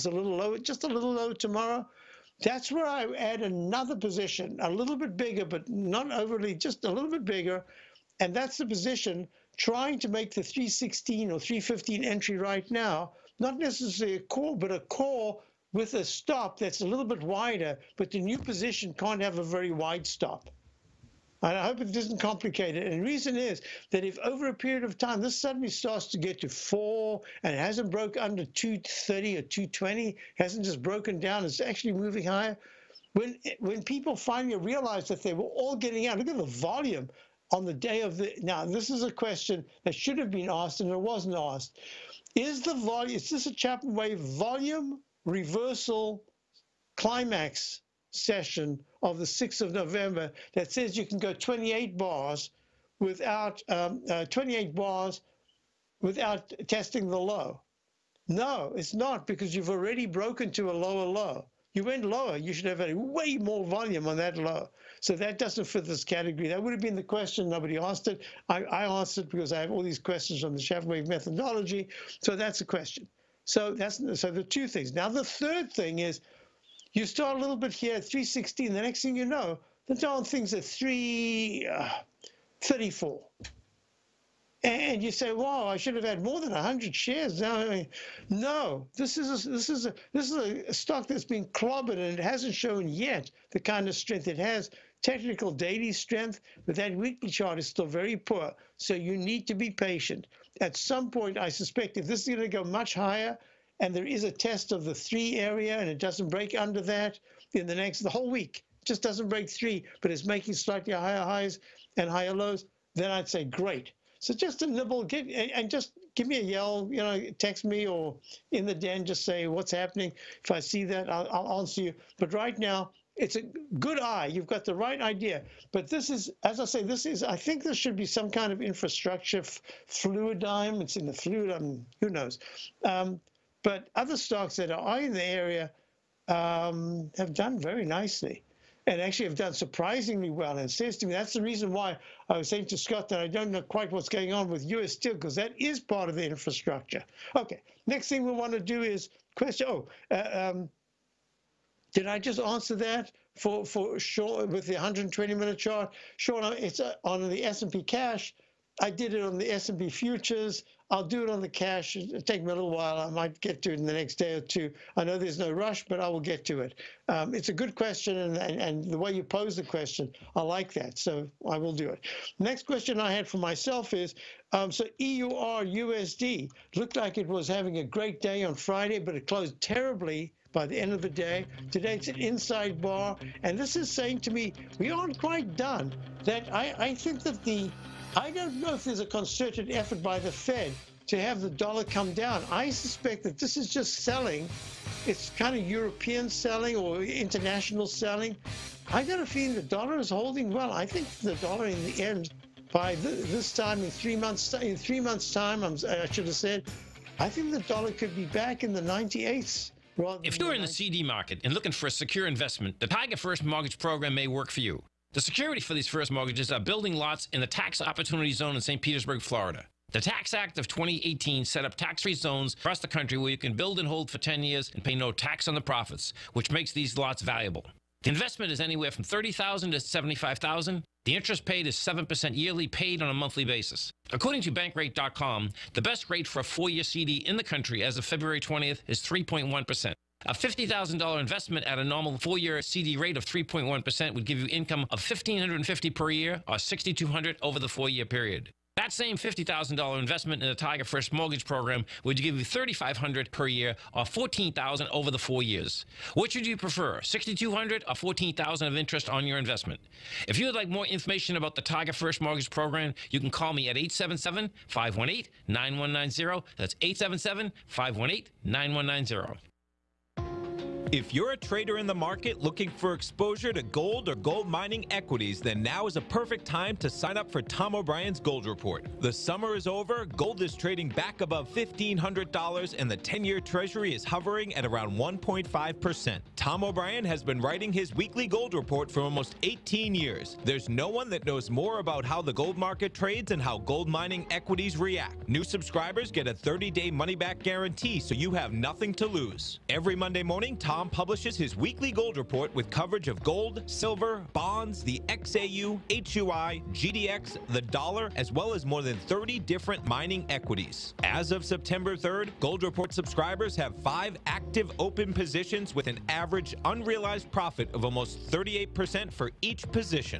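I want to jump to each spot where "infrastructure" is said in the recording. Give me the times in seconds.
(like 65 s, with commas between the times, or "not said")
128 s, 146 s.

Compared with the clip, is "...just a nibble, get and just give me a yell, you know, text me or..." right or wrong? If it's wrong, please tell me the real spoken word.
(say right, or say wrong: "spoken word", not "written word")
right.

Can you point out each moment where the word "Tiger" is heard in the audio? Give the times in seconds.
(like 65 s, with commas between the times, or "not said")
212 s, 250 s, 261 s.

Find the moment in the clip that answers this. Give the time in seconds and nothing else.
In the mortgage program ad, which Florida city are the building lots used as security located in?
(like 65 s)
218 s.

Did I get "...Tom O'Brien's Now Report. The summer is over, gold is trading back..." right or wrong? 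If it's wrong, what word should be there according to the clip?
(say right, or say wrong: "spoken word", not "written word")
wrong: "Gold", not "Now".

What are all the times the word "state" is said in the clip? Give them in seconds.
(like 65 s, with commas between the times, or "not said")
not said.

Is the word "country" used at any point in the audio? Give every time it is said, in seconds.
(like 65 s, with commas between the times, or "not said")
222 s, 237 s.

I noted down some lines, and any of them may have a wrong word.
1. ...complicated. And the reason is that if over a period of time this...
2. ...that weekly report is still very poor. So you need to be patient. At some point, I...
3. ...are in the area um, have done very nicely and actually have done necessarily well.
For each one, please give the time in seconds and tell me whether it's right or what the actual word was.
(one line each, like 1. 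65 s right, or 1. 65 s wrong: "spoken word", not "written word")
1. 22 s right
2. 96 s wrong: "chart", not "report"
3. 134 s wrong: "surprisingly", not "necessarily".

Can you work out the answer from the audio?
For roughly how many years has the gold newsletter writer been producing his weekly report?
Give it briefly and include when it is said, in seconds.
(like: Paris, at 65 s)
18 years, at 289 s.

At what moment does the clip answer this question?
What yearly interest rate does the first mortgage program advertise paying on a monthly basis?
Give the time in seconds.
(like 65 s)
231 s.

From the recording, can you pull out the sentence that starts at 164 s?
I know there's no rush, but I will get to it.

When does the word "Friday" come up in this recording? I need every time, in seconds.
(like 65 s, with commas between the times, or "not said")
178 s.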